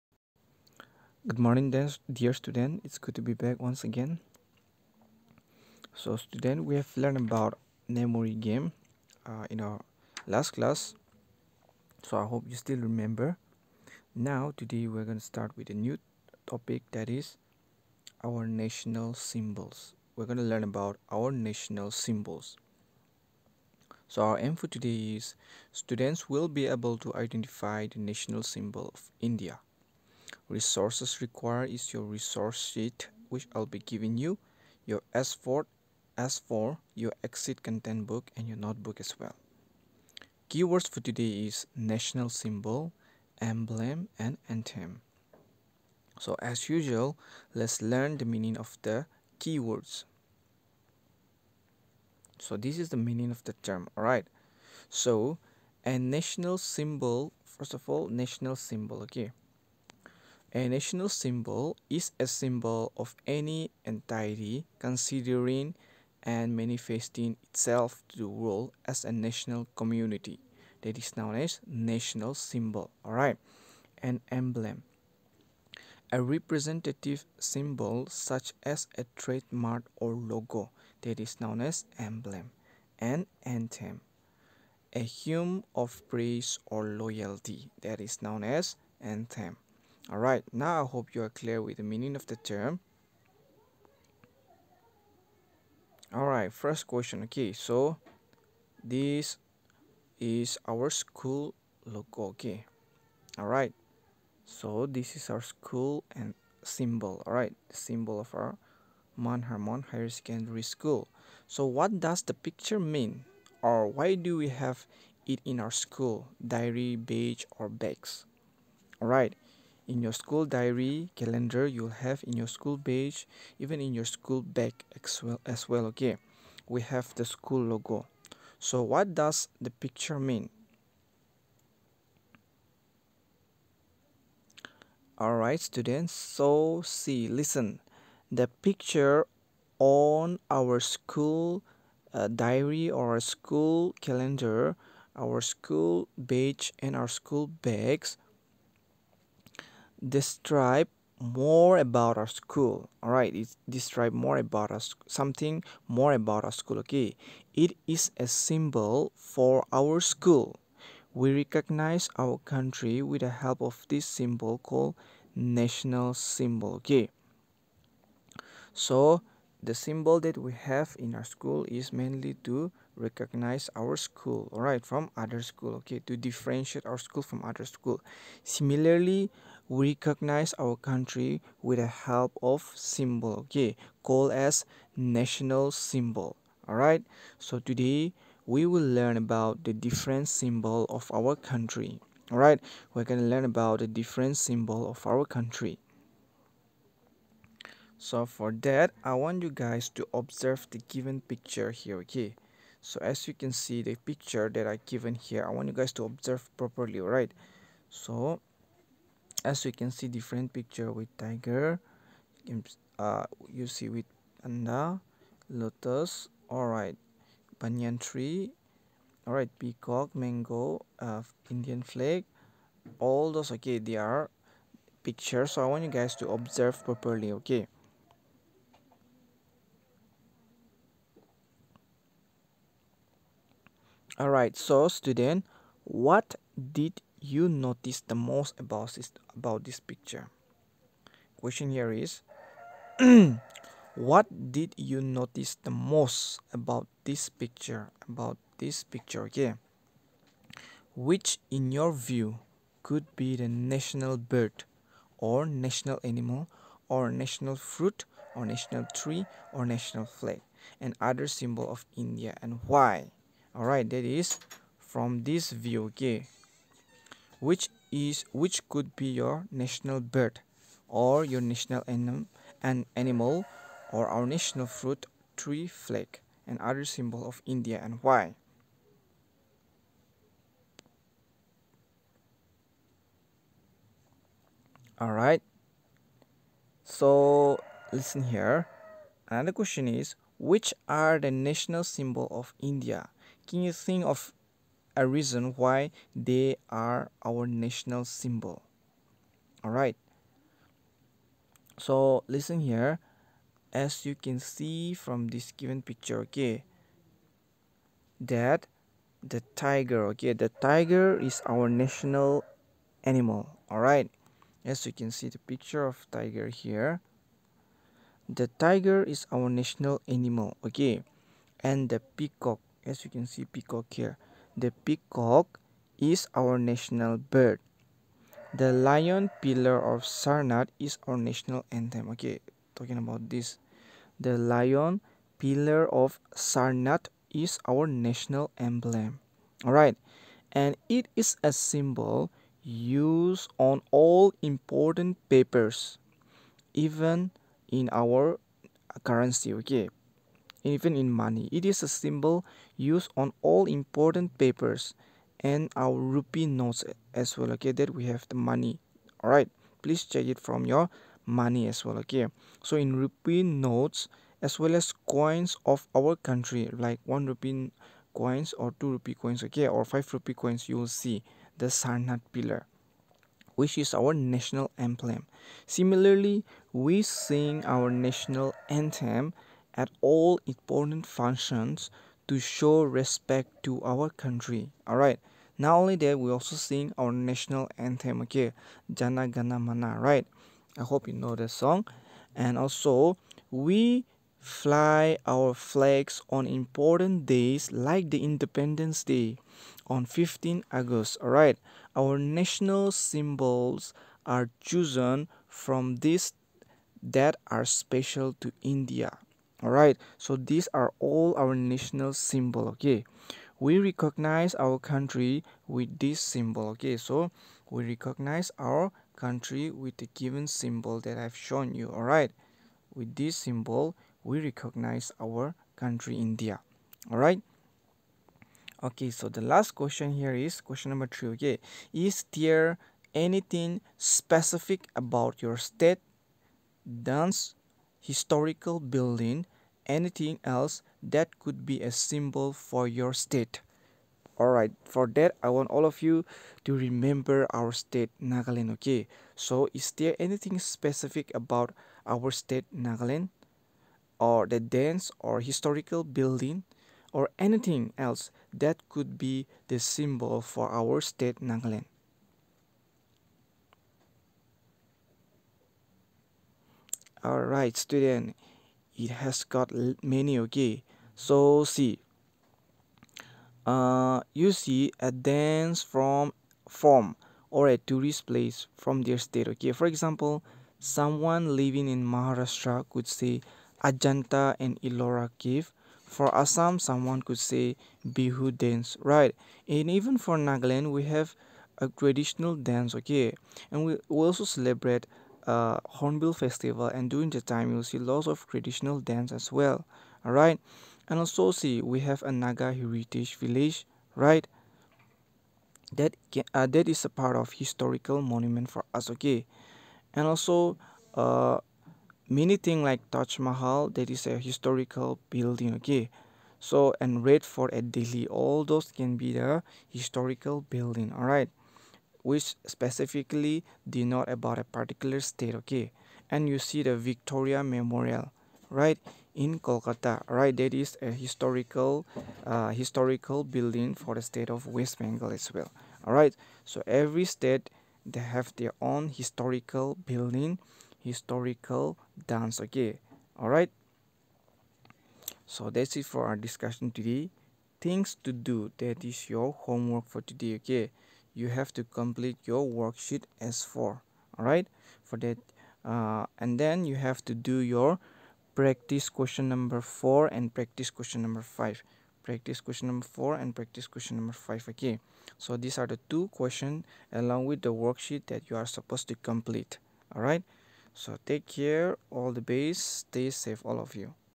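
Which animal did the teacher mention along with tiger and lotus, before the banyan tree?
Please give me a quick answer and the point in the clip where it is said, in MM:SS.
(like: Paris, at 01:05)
panda, at 03:34.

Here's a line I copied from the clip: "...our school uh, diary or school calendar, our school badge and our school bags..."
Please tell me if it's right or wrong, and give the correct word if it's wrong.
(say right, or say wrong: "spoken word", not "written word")
right.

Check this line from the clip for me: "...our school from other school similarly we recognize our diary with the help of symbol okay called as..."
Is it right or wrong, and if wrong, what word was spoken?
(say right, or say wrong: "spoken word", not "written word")
wrong: "country", not "diary".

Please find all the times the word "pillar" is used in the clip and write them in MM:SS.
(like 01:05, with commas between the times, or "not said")
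05:29, 05:35, 06:12.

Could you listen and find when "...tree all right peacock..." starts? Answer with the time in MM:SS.
03:37.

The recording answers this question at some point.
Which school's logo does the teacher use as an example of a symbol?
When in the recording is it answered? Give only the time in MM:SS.
01:49.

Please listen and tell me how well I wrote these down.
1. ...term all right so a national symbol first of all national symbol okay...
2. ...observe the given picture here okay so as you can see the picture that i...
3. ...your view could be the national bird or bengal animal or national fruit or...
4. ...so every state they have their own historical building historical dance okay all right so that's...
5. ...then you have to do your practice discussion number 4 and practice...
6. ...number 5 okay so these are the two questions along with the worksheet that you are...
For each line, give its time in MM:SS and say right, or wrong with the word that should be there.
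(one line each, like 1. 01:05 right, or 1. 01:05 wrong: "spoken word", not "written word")
1. 00:53 right
2. 03:20 right
3. 04:11 wrong: "national", not "bengal"
4. 08:56 right
5. 09:16 wrong: "question", not "discussion"
6. 09:24 right.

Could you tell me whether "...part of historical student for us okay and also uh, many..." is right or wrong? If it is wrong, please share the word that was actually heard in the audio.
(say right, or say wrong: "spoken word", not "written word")
wrong: "monument", not "student".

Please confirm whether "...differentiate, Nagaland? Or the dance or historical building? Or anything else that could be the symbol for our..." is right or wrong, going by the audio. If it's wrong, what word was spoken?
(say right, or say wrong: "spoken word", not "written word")
wrong: "state", not "differentiate".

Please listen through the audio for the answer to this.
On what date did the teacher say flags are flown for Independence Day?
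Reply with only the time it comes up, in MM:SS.
06:40.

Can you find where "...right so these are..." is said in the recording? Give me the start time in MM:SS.
06:49.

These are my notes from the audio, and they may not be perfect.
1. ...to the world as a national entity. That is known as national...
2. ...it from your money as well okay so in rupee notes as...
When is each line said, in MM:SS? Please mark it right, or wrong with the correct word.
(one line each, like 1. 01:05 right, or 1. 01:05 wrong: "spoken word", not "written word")
1. 01:08 wrong: "community", not "entity"
2. 06:00 right.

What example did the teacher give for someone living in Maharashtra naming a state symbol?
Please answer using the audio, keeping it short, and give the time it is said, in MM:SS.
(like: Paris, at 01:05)
Ajanta and Ellora cave, at 08:03.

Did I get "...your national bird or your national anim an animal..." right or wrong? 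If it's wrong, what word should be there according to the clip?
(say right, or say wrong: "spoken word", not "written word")
right.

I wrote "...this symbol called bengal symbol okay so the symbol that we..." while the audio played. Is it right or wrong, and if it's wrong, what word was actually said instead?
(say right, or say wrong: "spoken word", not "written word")
wrong: "national", not "bengal".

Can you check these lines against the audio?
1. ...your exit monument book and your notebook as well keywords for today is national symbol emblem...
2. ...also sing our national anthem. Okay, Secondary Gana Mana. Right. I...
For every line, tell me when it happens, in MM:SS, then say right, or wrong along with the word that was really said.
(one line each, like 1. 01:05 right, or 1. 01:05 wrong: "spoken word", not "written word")
1. 00:36 wrong: "content", not "monument"
2. 06:26 wrong: "Jana", not "Secondary".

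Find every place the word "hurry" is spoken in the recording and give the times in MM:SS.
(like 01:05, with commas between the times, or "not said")
not said.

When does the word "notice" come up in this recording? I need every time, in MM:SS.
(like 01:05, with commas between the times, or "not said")
03:57, 04:05.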